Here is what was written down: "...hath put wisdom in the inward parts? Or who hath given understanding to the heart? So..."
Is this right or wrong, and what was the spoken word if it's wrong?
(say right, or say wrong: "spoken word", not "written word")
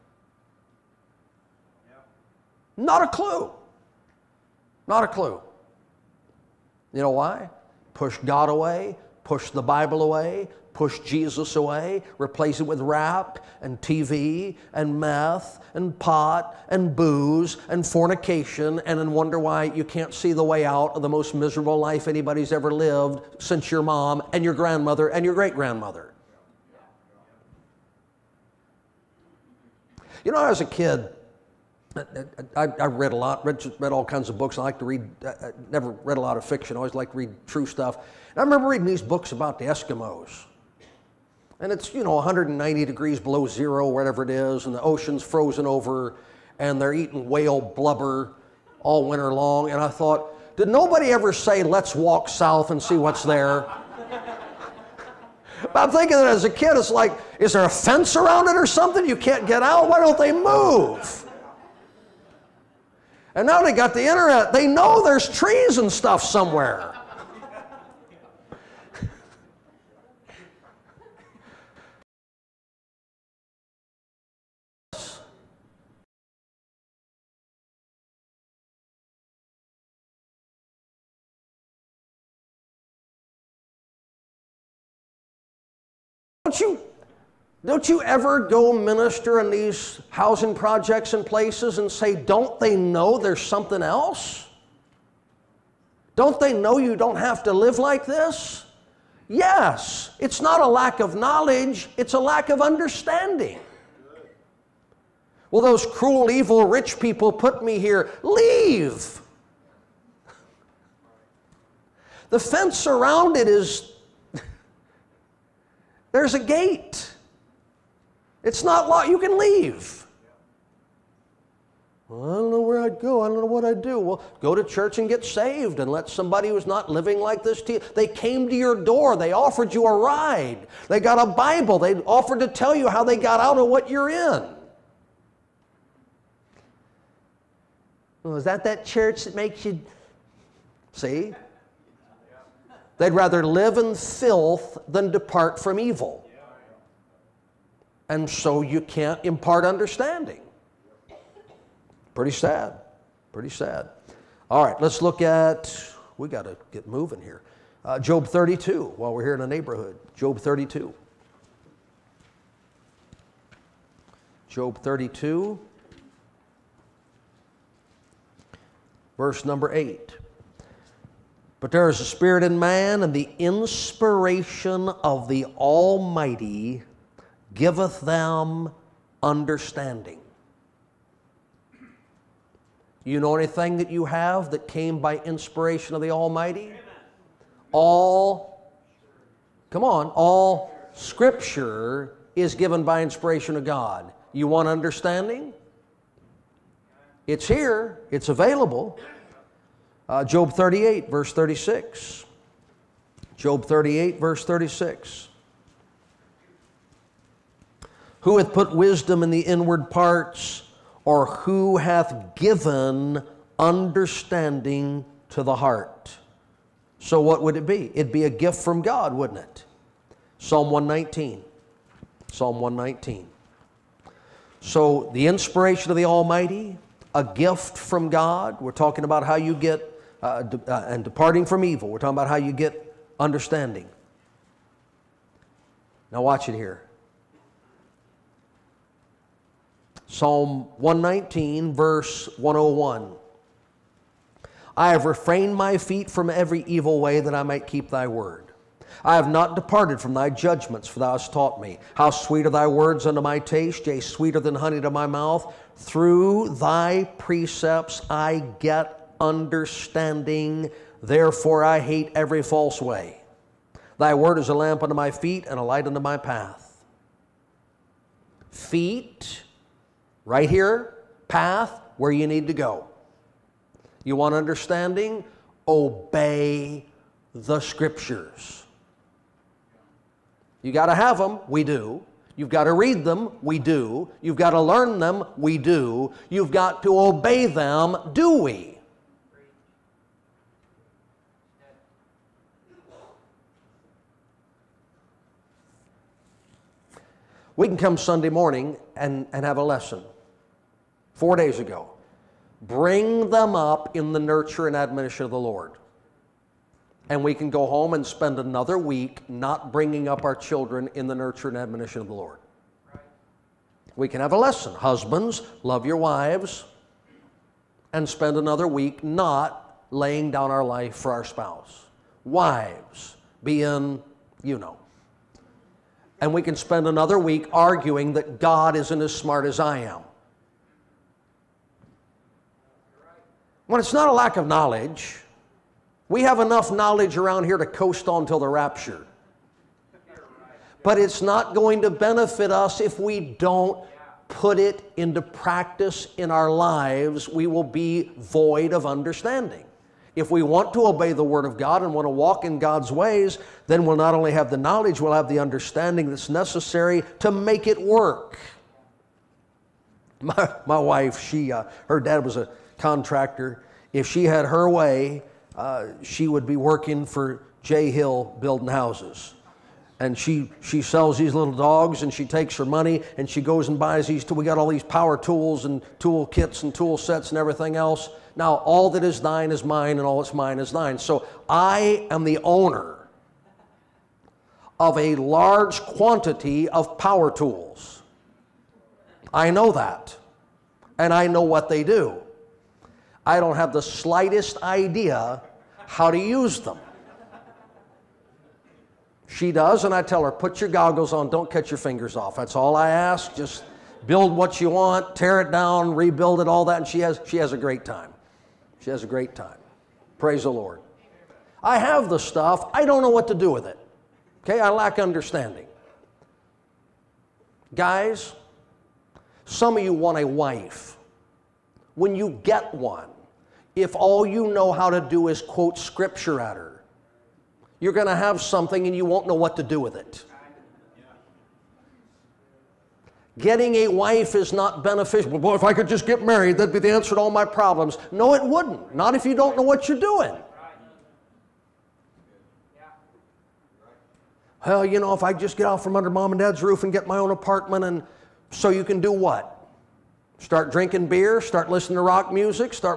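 right.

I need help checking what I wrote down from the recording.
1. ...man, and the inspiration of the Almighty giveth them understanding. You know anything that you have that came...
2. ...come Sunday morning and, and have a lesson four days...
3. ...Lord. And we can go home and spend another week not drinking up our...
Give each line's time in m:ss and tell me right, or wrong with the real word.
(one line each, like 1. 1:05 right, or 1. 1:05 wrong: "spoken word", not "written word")
1. 2:52 right
2. 4:57 right
3. 5:05 wrong: "bringing", not "drinking".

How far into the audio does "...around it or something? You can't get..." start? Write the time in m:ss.
0:58.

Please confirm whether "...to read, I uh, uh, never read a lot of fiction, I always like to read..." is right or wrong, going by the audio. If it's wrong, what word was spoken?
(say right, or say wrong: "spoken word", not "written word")
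right.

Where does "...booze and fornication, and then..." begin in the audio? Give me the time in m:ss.
0:16.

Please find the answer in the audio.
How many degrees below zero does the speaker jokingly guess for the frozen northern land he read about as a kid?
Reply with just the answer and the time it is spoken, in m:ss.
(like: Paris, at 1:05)
190, at 0:42.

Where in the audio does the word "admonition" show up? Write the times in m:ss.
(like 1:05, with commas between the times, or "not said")
5:04, 5:11.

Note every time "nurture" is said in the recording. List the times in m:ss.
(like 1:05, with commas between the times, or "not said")
5:04, 5:11.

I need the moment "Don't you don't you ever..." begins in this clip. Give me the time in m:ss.
1:26.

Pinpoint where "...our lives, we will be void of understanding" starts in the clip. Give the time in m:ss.
5:46.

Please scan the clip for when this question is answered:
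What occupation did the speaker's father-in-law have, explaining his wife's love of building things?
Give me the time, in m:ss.
6:02.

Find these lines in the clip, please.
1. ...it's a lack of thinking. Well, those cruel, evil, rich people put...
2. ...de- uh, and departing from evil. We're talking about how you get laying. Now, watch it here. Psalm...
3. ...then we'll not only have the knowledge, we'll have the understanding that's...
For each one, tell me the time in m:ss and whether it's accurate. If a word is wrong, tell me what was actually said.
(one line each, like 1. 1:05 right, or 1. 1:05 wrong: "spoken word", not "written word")
1. 1:41 wrong: "understanding", not "thinking"
2. 3:50 wrong: "understanding", not "laying"
3. 5:53 right.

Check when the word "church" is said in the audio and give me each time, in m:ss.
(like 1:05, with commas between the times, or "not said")
2:04, 2:18.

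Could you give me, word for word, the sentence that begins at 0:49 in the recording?
And I thought, did nobody ever say, let's walk south and see what's there?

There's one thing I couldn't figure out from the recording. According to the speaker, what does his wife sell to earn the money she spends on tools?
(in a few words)
little dogs.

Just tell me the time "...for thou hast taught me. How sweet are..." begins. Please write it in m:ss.
4:10.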